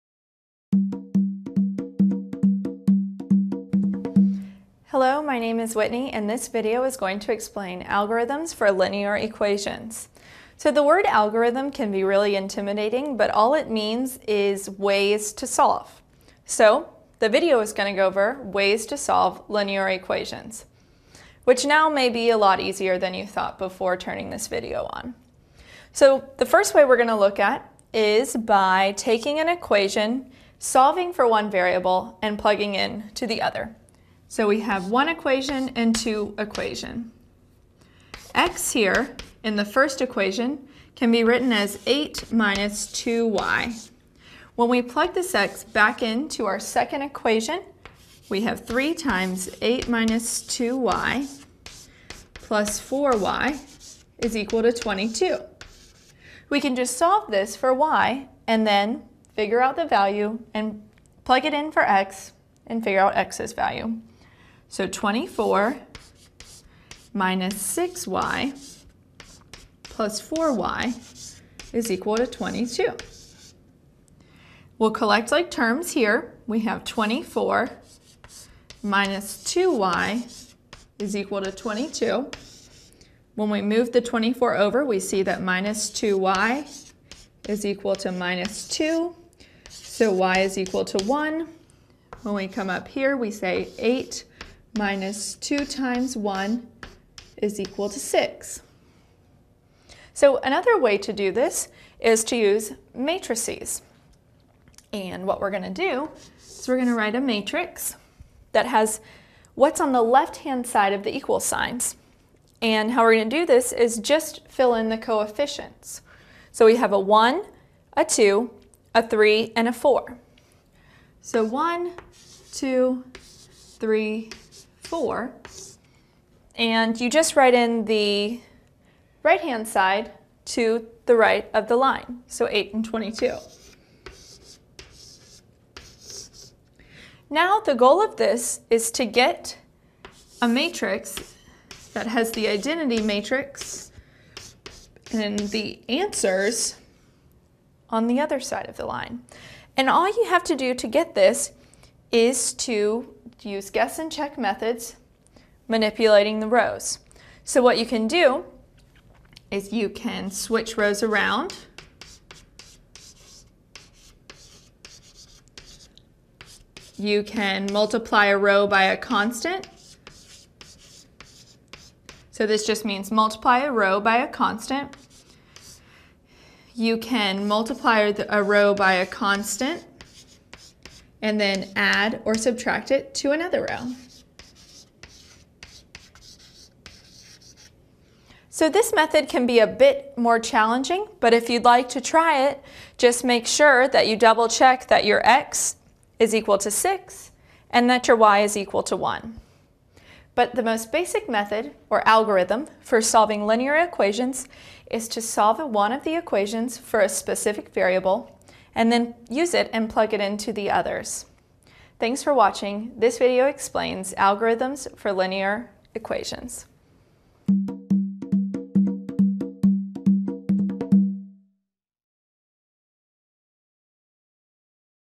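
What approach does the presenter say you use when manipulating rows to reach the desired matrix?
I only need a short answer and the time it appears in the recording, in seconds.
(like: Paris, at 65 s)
guess and check, at 153 s.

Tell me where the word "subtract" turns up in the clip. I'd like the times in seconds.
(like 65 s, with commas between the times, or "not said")
182 s.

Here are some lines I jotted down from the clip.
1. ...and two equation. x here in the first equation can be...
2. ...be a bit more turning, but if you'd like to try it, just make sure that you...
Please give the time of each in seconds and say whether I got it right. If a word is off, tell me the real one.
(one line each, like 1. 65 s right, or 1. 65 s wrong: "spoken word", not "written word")
1. 35 s right
2. 189 s wrong: "challenging", not "turning".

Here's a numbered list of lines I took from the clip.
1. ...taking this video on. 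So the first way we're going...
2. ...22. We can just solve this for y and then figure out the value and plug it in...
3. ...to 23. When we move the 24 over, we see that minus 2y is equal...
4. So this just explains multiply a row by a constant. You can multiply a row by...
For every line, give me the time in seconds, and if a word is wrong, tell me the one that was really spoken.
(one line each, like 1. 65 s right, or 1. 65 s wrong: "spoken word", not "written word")
1. 23 s wrong: "turning", not "taking"
2. 54 s right
3. 81 s wrong: "22", not "23"
4. 172 s wrong: "means", not "explains".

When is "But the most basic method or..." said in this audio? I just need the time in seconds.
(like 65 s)
200 s.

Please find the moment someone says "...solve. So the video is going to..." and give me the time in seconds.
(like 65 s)
15 s.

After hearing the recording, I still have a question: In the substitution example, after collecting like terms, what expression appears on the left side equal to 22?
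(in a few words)
24 minus 2y.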